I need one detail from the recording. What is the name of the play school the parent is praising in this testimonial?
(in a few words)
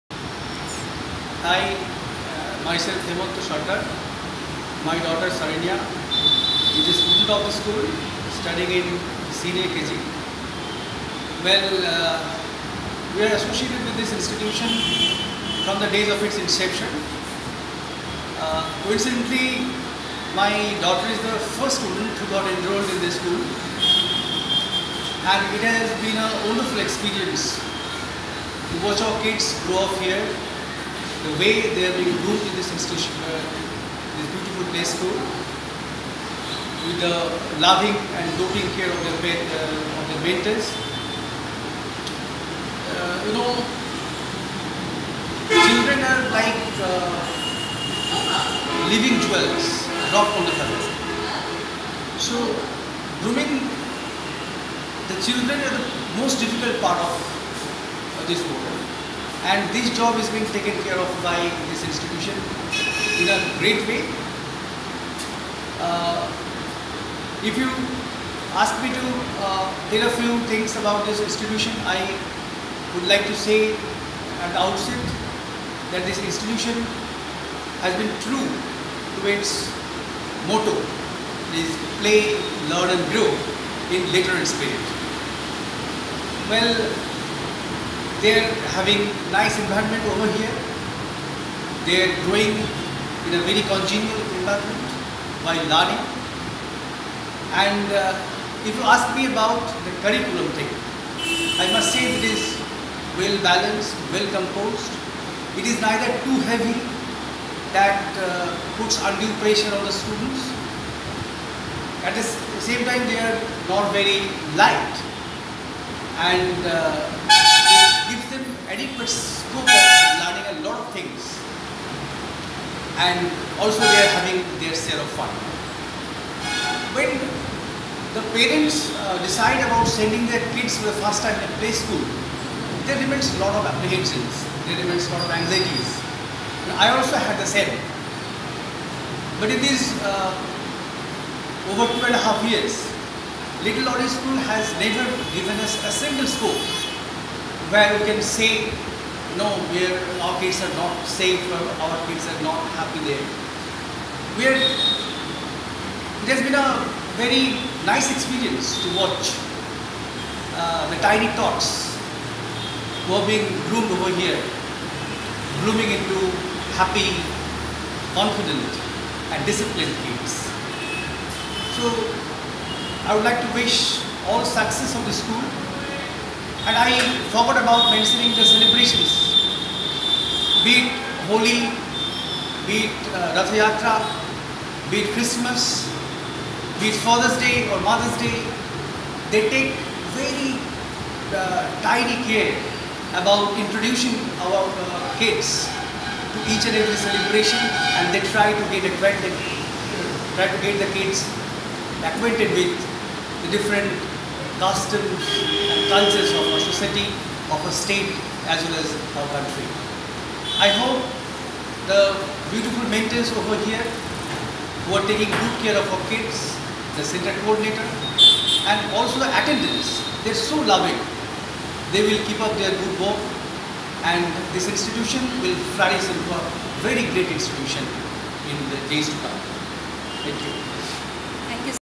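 Little Laureates School.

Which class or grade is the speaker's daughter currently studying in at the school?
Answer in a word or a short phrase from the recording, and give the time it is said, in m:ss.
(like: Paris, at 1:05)
Senior KG, at 0:09.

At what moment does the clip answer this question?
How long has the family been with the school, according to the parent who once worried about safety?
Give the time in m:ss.
2:21.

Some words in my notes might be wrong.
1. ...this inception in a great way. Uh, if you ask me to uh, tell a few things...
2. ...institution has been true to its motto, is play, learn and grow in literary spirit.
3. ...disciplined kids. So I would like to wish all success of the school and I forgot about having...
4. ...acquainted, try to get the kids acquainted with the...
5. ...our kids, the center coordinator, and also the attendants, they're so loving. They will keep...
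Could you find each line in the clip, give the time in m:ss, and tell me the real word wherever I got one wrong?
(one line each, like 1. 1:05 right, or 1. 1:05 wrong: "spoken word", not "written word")
1. 1:01 wrong: "institution", not "inception"
2. 1:16 right
3. 2:49 wrong: "mentioning", not "having"
4. 3:18 right
5. 3:35 right.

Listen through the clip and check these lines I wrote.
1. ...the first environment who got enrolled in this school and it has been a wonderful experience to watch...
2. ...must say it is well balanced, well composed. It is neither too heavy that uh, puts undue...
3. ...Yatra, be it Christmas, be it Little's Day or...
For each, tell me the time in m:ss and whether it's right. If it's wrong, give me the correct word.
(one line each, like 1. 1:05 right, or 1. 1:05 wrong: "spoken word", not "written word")
1. 0:21 wrong: "student", not "environment"
2. 1:41 right
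3. 3:03 wrong: "Father", not "Little".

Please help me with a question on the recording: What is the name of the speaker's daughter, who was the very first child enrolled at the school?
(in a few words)
Saranya.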